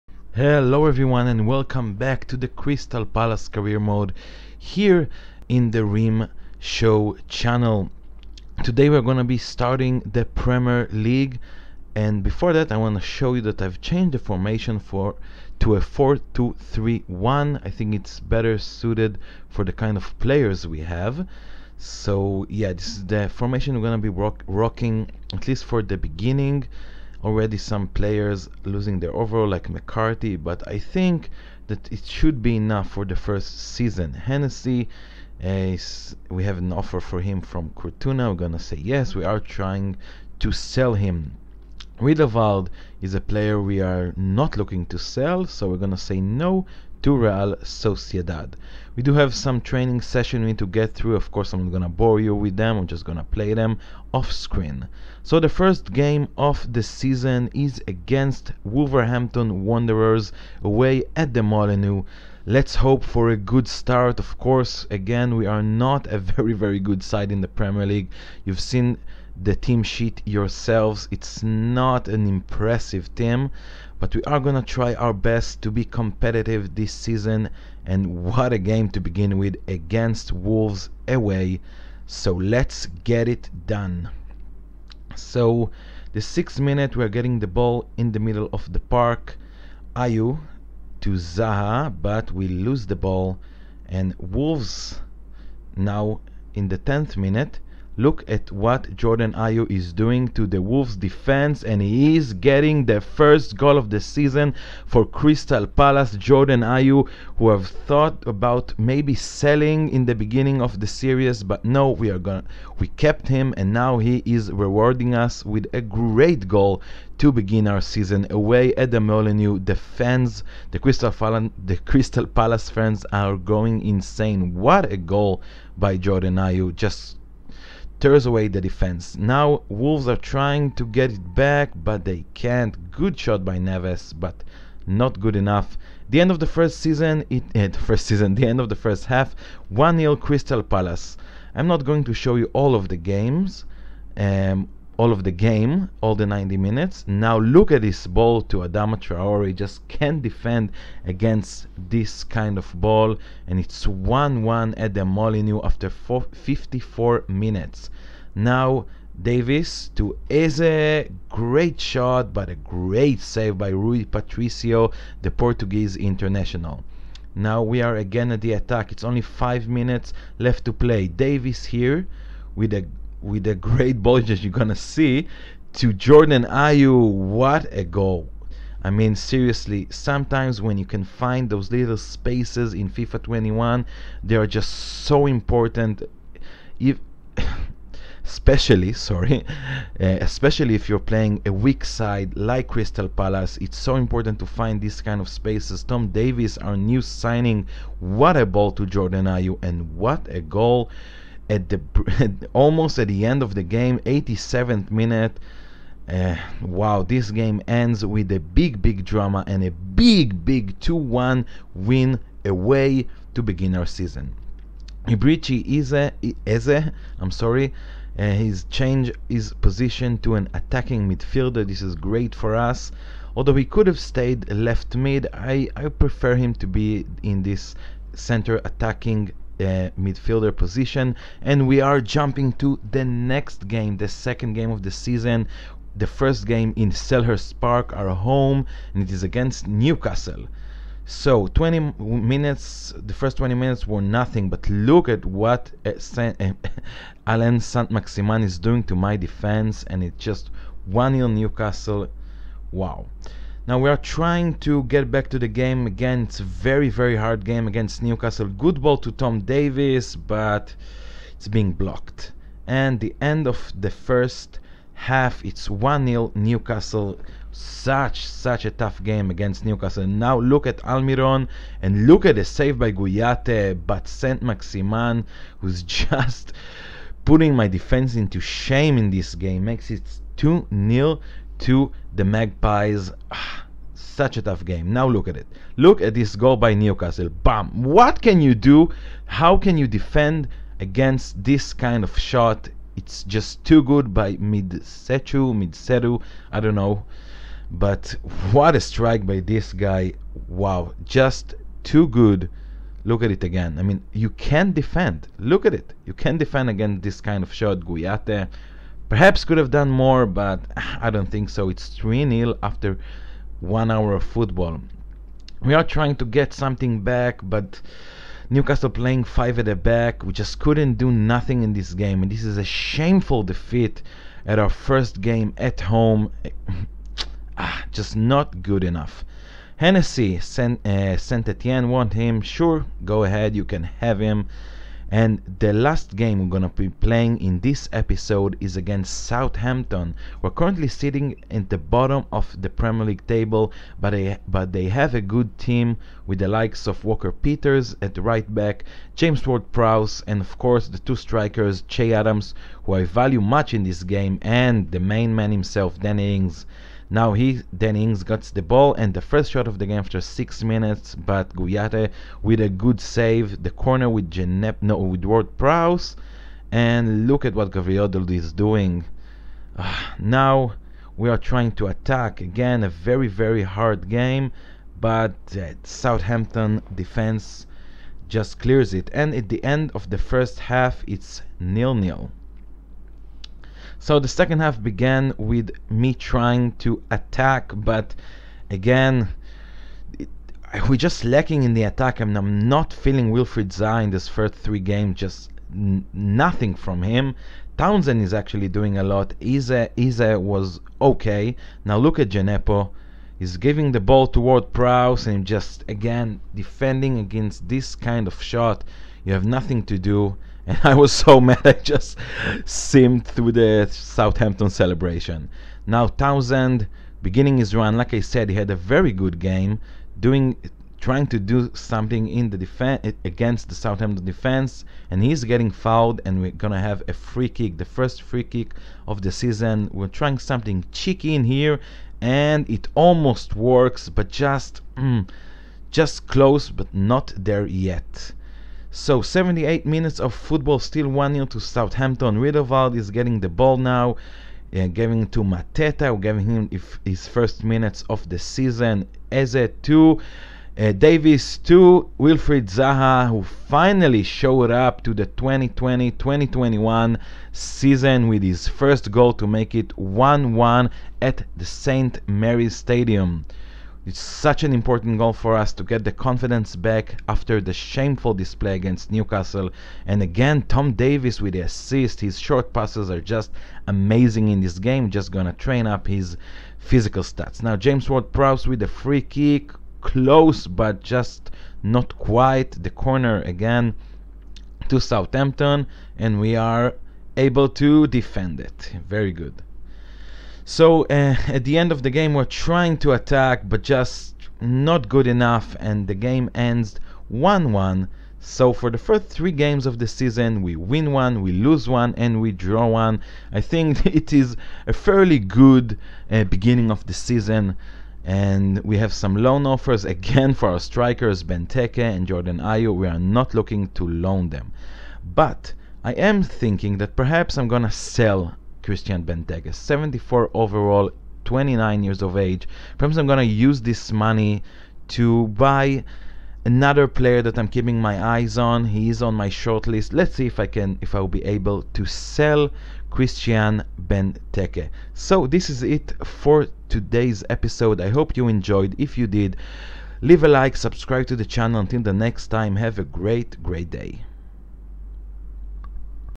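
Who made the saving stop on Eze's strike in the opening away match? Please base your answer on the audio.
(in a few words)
Rui Patricio.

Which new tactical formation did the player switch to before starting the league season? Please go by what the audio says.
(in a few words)
4-2-3-1.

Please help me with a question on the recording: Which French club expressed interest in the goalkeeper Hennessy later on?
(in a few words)
Saint Etienne.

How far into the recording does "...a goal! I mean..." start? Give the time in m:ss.
2:57.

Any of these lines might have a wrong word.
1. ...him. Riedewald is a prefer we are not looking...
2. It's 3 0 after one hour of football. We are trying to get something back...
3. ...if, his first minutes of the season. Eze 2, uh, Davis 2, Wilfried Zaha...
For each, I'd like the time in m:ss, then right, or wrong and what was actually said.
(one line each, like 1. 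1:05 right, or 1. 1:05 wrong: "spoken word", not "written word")
1. 0:40 wrong: "player", not "prefer"
2. 5:11 right
3. 7:26 right.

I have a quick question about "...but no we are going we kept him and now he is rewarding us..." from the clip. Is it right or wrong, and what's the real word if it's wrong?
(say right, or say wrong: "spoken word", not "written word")
right.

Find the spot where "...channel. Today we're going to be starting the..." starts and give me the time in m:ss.
0:07.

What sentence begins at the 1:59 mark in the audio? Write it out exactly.
The fans, the Crystal, Palace, the Crystal Palace fans are going insane.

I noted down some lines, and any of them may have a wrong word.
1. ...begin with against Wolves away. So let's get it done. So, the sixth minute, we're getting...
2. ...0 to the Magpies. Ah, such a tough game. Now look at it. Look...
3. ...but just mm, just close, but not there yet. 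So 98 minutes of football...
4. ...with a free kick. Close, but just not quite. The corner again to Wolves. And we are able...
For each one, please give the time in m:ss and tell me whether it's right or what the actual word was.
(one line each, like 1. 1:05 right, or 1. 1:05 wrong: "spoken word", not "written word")
1. 1:18 right
2. 4:40 right
3. 7:14 wrong: "78", not "98"
4. 7:58 wrong: "Southampton", not "Wolves".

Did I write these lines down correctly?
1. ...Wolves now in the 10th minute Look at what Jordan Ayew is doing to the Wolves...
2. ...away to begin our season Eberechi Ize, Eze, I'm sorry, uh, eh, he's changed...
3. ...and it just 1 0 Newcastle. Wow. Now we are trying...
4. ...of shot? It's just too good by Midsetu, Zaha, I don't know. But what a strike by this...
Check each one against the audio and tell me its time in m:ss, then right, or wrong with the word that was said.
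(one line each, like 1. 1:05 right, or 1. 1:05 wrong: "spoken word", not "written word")
1. 1:34 right
2. 3:32 right
3. 4:09 right
4. 4:52 wrong: "Midsetu", not "Zaha".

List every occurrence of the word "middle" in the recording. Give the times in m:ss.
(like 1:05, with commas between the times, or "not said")
1:28.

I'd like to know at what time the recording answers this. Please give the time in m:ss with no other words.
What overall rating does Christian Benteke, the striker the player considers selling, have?
8:39.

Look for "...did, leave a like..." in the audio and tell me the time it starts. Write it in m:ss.
8:59.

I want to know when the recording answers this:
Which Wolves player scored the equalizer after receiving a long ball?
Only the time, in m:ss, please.
2:28.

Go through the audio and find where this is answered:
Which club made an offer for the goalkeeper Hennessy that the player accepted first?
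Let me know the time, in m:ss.
0:37.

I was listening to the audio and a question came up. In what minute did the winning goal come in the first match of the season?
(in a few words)
87th minute.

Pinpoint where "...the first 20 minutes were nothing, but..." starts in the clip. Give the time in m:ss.
4:02.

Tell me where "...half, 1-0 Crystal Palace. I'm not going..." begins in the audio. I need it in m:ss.
2:19.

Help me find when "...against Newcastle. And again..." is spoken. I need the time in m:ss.
7:48.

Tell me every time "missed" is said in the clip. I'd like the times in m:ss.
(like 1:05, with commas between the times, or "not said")
not said.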